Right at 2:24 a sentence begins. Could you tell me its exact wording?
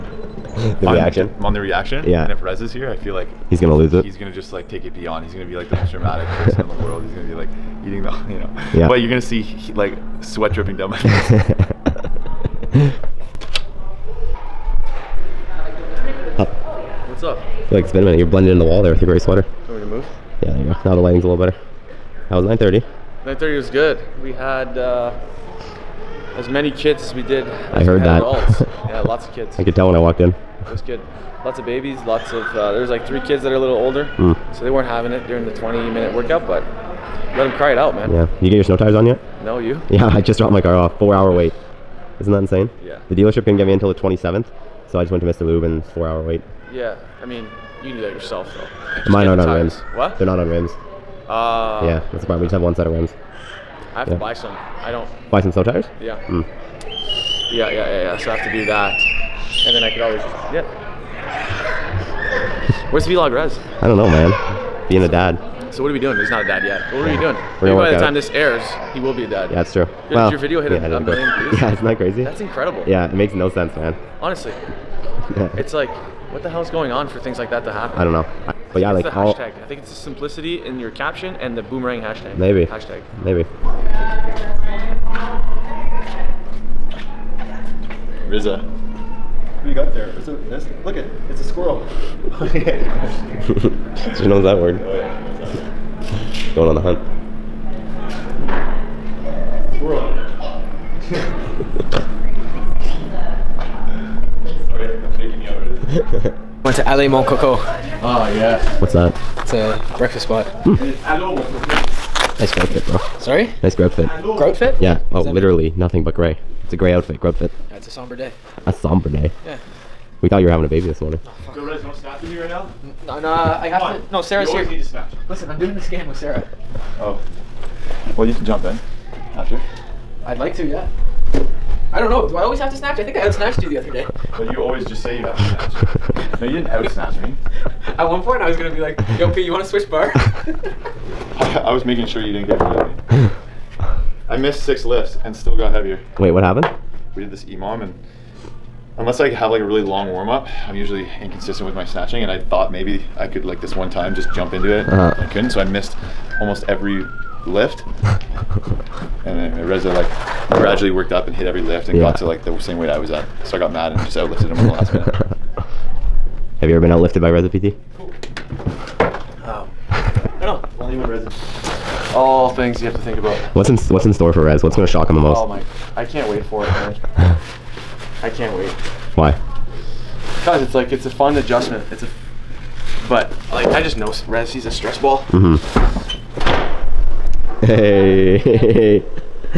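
I missed six lifts and still got heavier.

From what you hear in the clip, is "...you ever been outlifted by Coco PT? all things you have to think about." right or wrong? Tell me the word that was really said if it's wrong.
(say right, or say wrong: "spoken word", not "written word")
wrong: "Reza", not "Coco".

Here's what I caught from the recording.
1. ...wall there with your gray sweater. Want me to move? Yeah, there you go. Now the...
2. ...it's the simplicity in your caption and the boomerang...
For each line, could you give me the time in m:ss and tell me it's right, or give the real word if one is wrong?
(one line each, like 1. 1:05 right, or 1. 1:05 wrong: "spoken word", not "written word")
1. 0:18 right
2. 1:19 right.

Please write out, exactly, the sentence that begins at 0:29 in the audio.
I could tell when I walked in.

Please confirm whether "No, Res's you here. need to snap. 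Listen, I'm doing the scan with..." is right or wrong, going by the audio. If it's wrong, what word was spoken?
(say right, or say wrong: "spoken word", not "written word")
wrong: "Sarah", not "Res".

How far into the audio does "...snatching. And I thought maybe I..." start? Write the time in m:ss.
2:31.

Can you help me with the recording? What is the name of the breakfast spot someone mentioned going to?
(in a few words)
LA Mon Coco.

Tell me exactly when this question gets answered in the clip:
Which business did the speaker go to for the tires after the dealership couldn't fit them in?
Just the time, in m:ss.
0:45.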